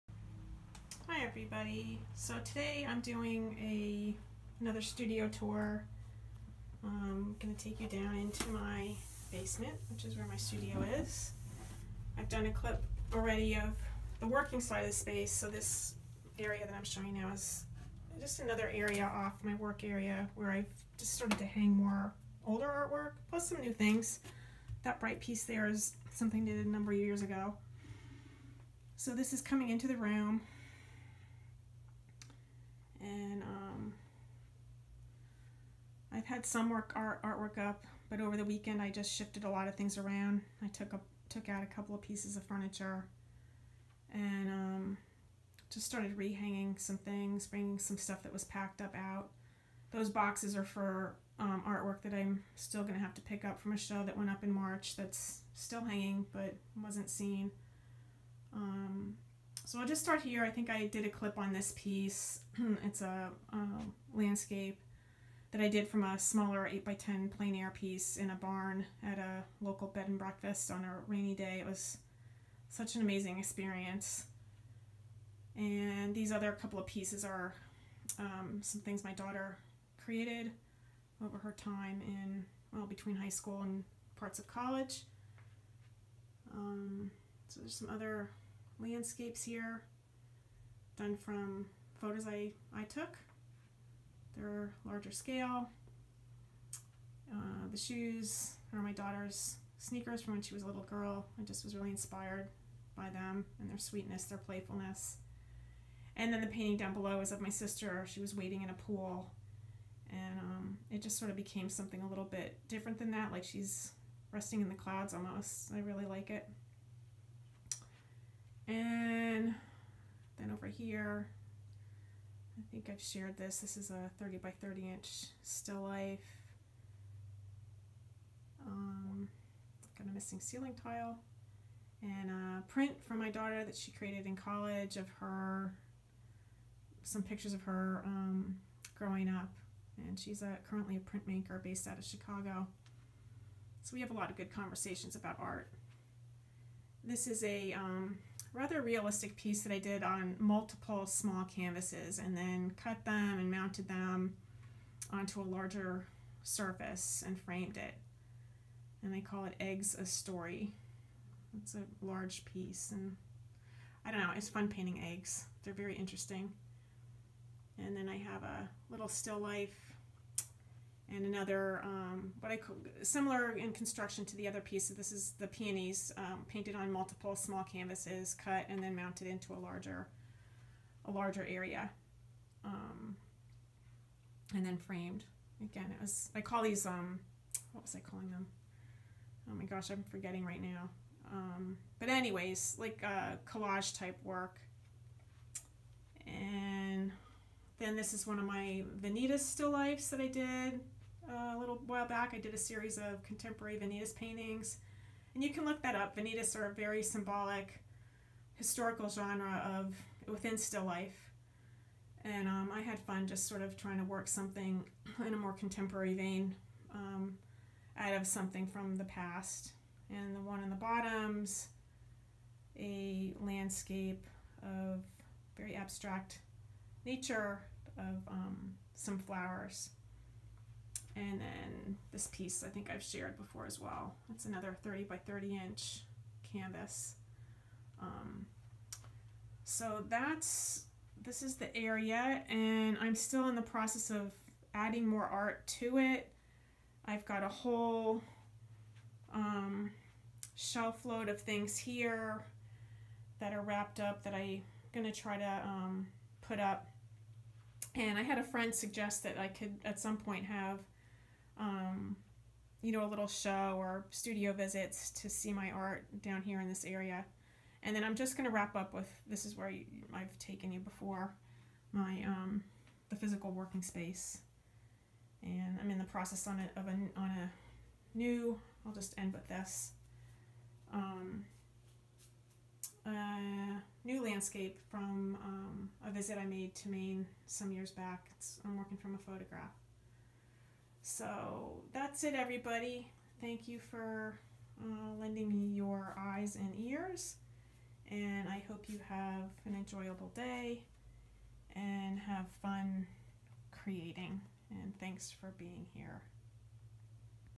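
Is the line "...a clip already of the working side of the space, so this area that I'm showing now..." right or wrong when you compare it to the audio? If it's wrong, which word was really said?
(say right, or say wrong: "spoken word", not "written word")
right.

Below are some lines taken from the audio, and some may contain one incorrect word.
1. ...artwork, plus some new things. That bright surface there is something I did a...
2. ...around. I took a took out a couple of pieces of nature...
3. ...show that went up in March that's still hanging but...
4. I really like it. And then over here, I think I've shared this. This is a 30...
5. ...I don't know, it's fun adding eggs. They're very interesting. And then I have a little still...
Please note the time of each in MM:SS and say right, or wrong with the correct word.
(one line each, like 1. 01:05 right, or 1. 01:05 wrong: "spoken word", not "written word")
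1. 00:22 wrong: "piece", not "surface"
2. 00:39 wrong: "furniture", not "nature"
3. 00:53 right
4. 01:55 right
5. 02:44 wrong: "painting", not "adding".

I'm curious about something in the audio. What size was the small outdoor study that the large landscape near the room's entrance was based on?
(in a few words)
8 by 10.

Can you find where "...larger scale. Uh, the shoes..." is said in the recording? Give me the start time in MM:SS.
01:34.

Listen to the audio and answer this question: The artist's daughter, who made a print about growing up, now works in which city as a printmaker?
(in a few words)
Chicago.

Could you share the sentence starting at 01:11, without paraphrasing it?
It was such an amazing experience.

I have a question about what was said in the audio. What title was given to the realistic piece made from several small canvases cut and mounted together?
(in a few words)
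Eggs a Story.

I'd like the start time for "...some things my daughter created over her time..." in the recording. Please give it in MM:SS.
01:18.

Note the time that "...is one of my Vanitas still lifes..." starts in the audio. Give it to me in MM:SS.
03:18.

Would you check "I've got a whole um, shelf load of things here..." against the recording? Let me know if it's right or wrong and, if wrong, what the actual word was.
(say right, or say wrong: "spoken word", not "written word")
right.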